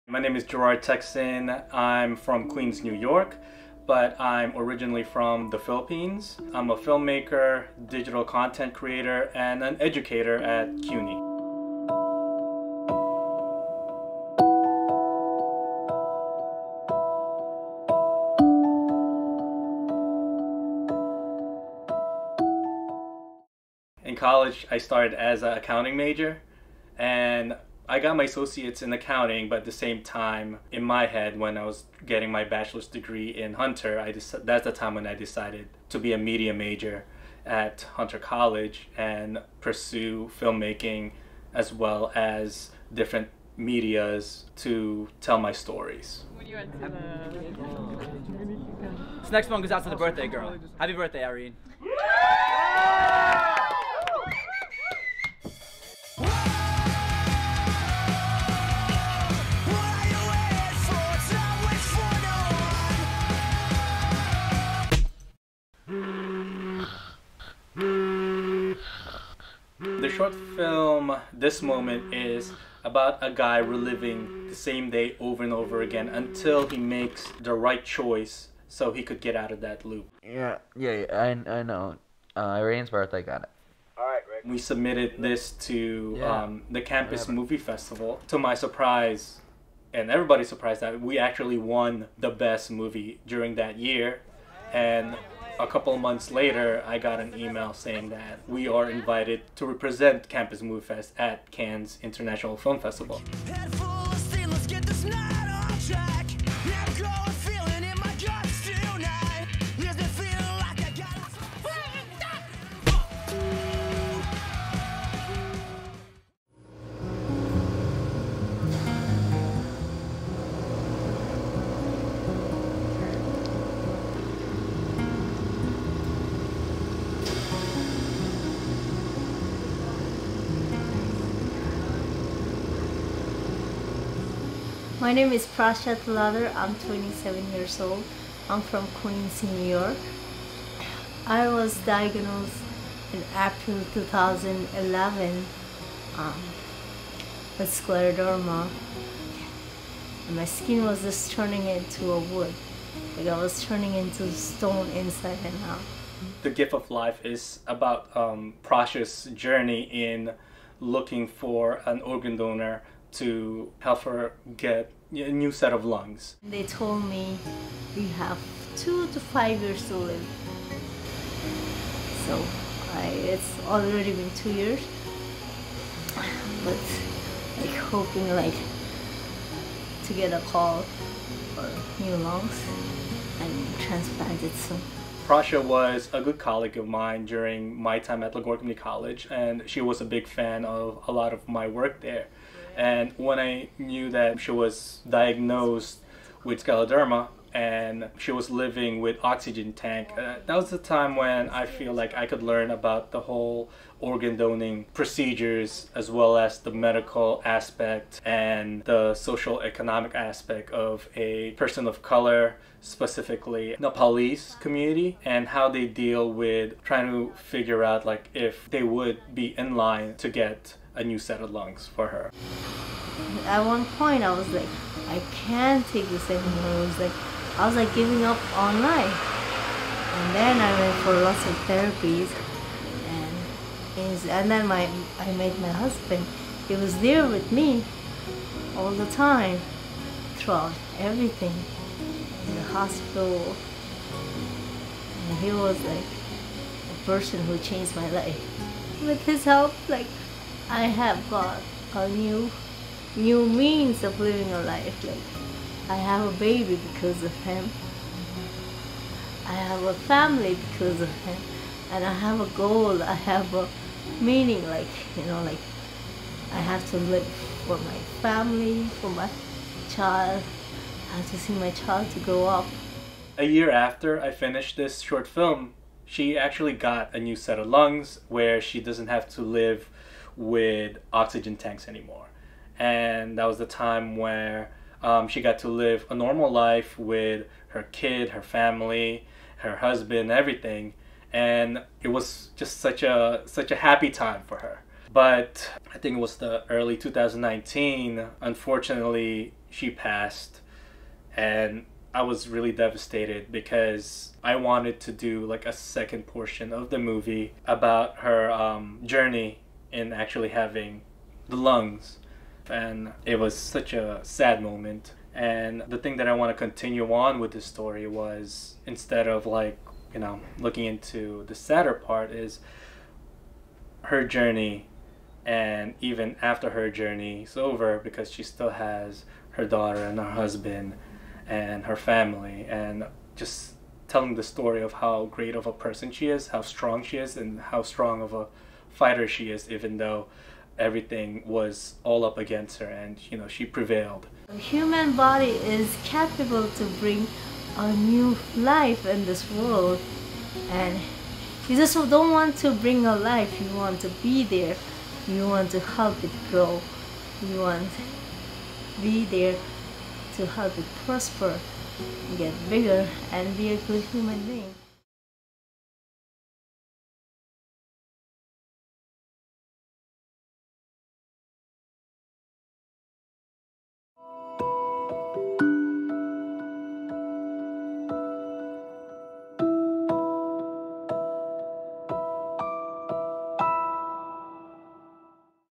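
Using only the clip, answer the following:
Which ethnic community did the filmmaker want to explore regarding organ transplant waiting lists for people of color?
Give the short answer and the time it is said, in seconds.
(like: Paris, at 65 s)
Nepalese, at 213 s.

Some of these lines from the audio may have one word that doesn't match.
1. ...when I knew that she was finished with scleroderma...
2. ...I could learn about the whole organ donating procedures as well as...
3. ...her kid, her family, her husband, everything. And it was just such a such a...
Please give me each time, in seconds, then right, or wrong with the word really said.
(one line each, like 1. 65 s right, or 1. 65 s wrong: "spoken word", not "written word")
1. 193 s wrong: "diagnosed", not "finished"
2. 202 s right
3. 287 s right.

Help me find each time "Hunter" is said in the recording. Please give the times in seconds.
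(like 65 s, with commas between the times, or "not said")
33 s, 37 s.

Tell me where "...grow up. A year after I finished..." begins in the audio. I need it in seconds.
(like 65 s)
272 s.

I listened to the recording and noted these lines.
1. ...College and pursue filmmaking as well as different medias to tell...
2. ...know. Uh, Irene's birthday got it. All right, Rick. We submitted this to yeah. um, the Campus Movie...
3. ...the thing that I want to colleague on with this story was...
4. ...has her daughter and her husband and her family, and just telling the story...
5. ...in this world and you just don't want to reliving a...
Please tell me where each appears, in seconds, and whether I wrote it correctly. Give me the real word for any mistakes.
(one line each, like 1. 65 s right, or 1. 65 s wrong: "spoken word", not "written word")
1. 38 s right
2. 81 s right
3. 315 s wrong: "continue", not "colleague"
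4. 328 s right
5. 349 s wrong: "bring", not "reliving".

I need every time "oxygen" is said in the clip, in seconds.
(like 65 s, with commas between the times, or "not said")
199 s, 281 s.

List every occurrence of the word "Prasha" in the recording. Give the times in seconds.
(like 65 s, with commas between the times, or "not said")
135 s, 185 s.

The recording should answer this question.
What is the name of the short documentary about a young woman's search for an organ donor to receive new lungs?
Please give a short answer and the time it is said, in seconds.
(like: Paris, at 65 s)
The Gift of Life, at 156 s.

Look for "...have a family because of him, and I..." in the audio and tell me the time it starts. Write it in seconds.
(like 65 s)
259 s.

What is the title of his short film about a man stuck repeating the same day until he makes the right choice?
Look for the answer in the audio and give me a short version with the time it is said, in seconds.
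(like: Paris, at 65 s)
This Moment, at 71 s.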